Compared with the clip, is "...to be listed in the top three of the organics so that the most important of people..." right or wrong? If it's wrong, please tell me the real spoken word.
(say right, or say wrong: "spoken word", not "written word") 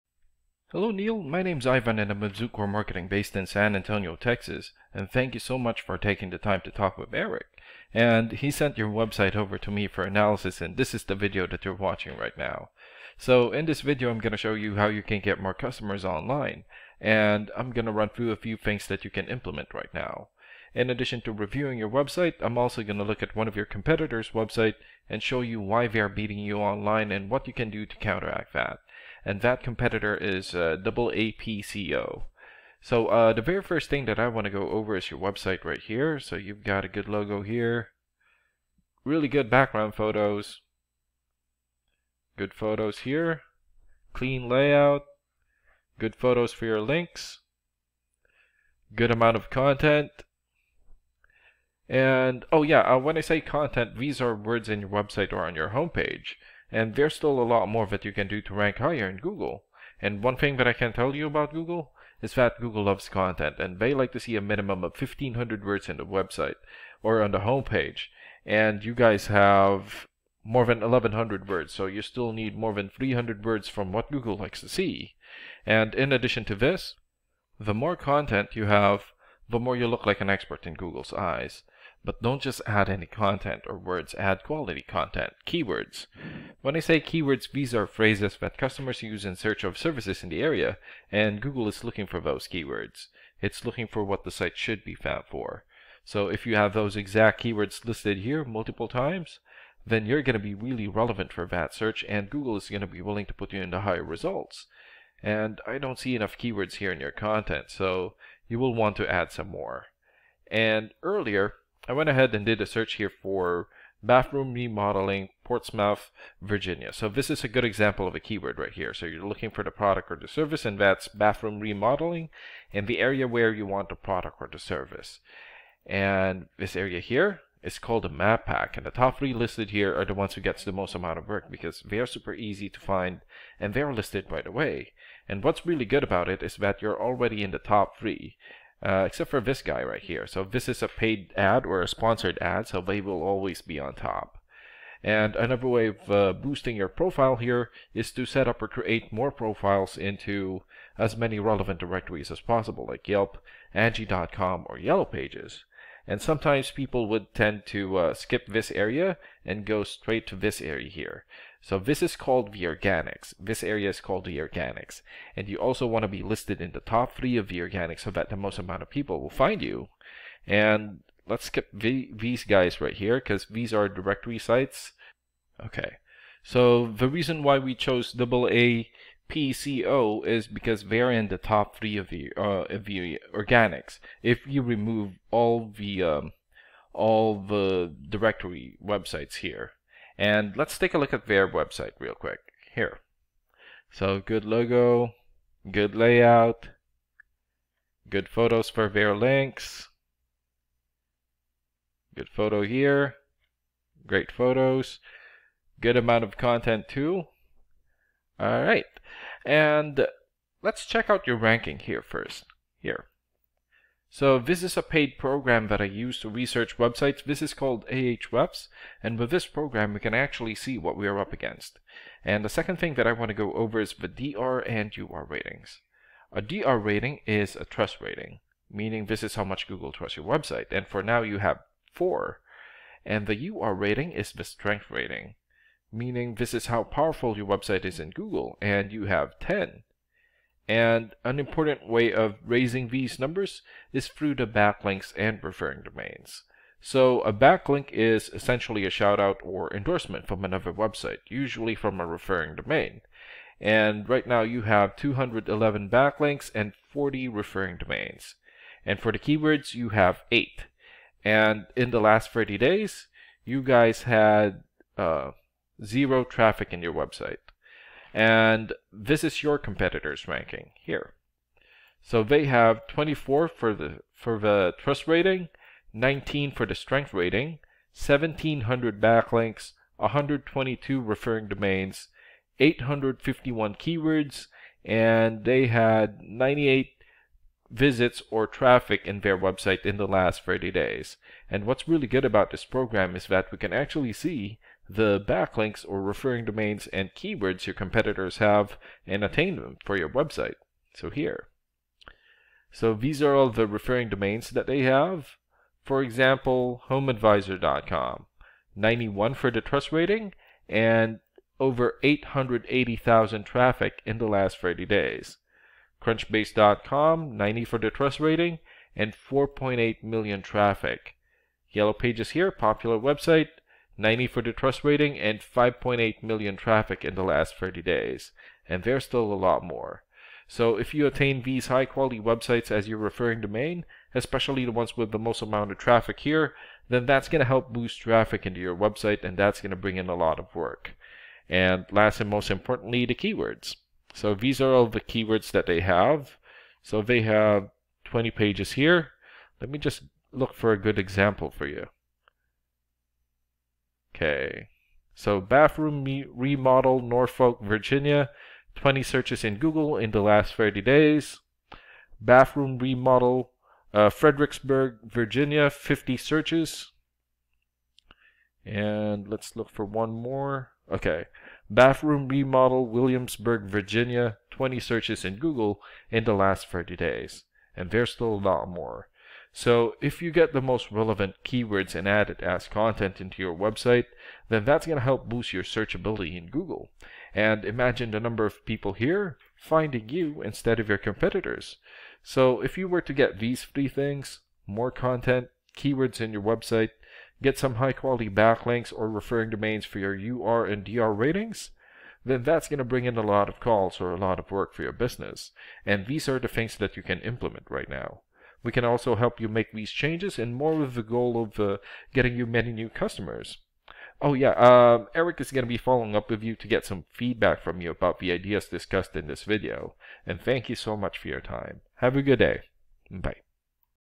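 wrong: "amount", not "important".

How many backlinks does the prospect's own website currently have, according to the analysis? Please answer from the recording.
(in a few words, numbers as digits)
211.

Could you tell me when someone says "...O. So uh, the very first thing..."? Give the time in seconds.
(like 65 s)
31 s.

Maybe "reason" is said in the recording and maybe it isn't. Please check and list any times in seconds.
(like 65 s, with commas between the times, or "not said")
177 s.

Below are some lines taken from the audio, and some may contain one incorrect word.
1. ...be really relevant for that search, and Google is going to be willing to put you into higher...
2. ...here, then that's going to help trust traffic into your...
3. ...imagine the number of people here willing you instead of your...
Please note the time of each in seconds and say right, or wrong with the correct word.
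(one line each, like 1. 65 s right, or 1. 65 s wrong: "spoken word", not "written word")
1. 100 s right
2. 336 s wrong: "boost", not "trust"
3. 387 s wrong: "finding", not "willing".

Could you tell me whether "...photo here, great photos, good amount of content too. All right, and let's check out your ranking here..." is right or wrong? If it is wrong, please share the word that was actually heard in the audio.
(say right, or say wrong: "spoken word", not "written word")
right.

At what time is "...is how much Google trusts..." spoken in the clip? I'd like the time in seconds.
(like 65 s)
229 s.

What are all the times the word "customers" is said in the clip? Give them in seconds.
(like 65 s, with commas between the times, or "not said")
15 s, 88 s, 412 s.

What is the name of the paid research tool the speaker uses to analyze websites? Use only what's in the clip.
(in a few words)
Ahrefs.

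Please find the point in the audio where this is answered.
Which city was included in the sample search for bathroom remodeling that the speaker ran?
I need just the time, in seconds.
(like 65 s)
115 s.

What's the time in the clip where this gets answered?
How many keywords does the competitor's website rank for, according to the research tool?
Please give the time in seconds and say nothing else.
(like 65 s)
282 s.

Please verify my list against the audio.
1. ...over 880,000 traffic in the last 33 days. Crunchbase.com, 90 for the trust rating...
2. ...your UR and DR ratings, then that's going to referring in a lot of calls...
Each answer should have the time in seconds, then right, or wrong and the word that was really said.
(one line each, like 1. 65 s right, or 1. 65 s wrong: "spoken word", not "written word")
1. 311 s wrong: "30", not "33"
2. 399 s wrong: "bring", not "referring".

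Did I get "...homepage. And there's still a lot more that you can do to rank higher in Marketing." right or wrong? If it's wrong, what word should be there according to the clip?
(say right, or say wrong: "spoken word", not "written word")
wrong: "Google", not "Marketing".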